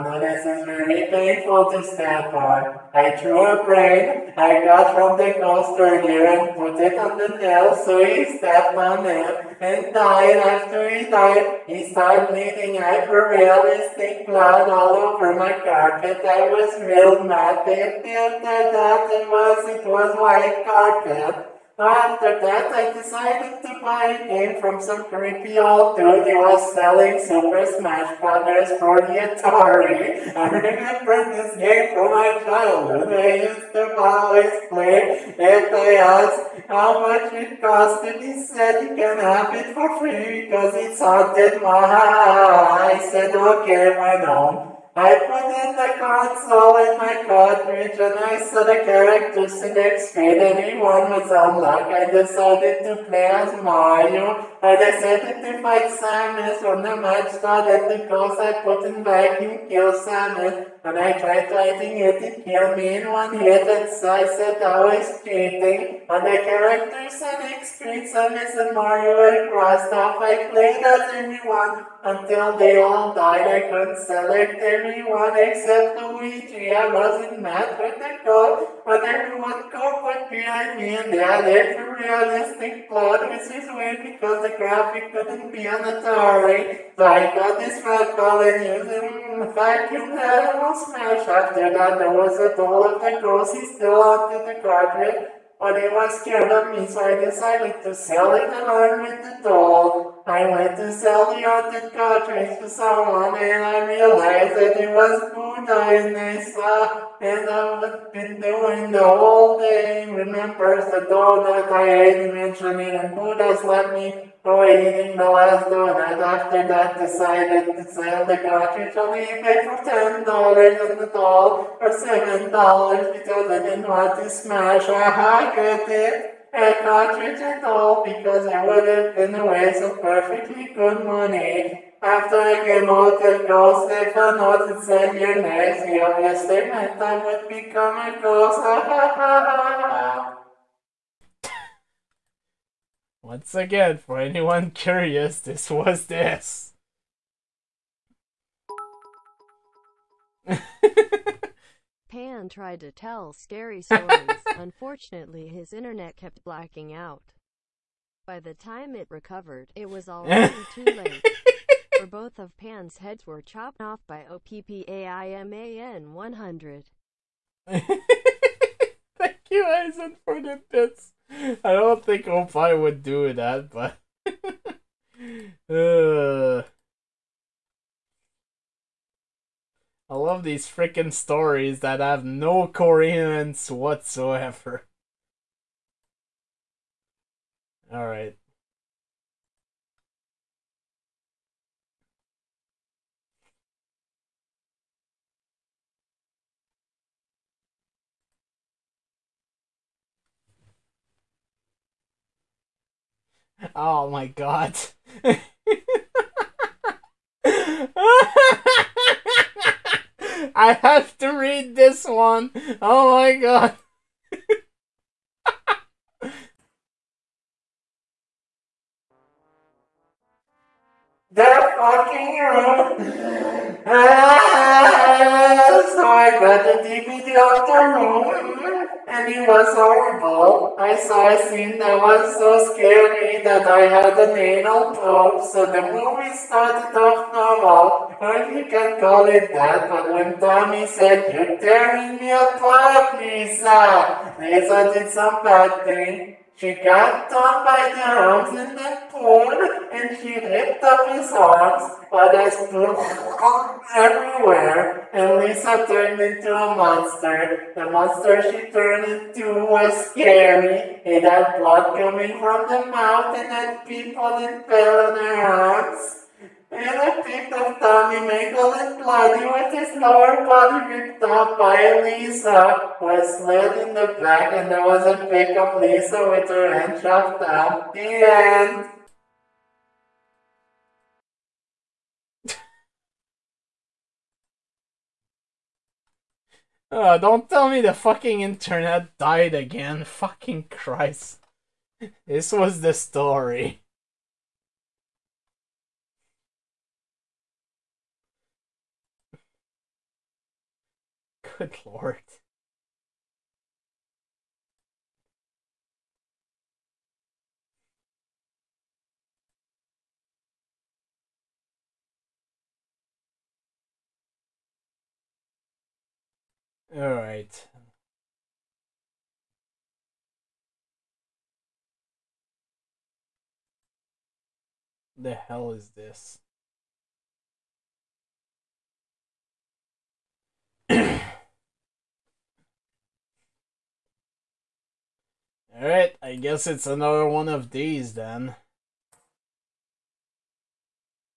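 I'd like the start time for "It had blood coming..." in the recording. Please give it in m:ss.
4:21.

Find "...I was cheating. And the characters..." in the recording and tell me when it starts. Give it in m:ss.
1:04.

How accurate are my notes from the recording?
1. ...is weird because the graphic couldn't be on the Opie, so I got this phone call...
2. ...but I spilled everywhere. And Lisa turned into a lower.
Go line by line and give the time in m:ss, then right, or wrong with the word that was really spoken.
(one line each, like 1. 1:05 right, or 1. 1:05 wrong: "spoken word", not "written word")
1. 1:23 wrong: "Atari", not "Opie"
2. 4:12 wrong: "monster", not "lower".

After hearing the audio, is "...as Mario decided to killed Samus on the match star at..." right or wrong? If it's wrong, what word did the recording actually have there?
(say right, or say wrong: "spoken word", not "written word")
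wrong: "certified", not "killed".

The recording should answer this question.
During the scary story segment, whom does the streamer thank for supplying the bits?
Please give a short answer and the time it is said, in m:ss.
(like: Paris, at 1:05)
Aizen, at 2:49.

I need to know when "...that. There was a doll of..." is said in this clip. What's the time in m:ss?
1:31.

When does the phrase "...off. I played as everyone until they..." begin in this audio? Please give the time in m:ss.
1:09.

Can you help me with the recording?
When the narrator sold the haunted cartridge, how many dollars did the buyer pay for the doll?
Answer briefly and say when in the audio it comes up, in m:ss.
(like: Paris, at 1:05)
7, at 2:01.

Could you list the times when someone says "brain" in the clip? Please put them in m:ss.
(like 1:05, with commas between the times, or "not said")
0:03.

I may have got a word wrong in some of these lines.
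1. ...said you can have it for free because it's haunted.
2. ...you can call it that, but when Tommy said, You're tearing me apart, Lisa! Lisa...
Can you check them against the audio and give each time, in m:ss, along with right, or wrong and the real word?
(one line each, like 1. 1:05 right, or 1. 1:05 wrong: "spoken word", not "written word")
1. 0:38 right
2. 3:58 right.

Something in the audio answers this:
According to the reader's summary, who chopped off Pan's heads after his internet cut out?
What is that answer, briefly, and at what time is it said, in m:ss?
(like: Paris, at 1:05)
OPPAIMAN 100, at 2:44.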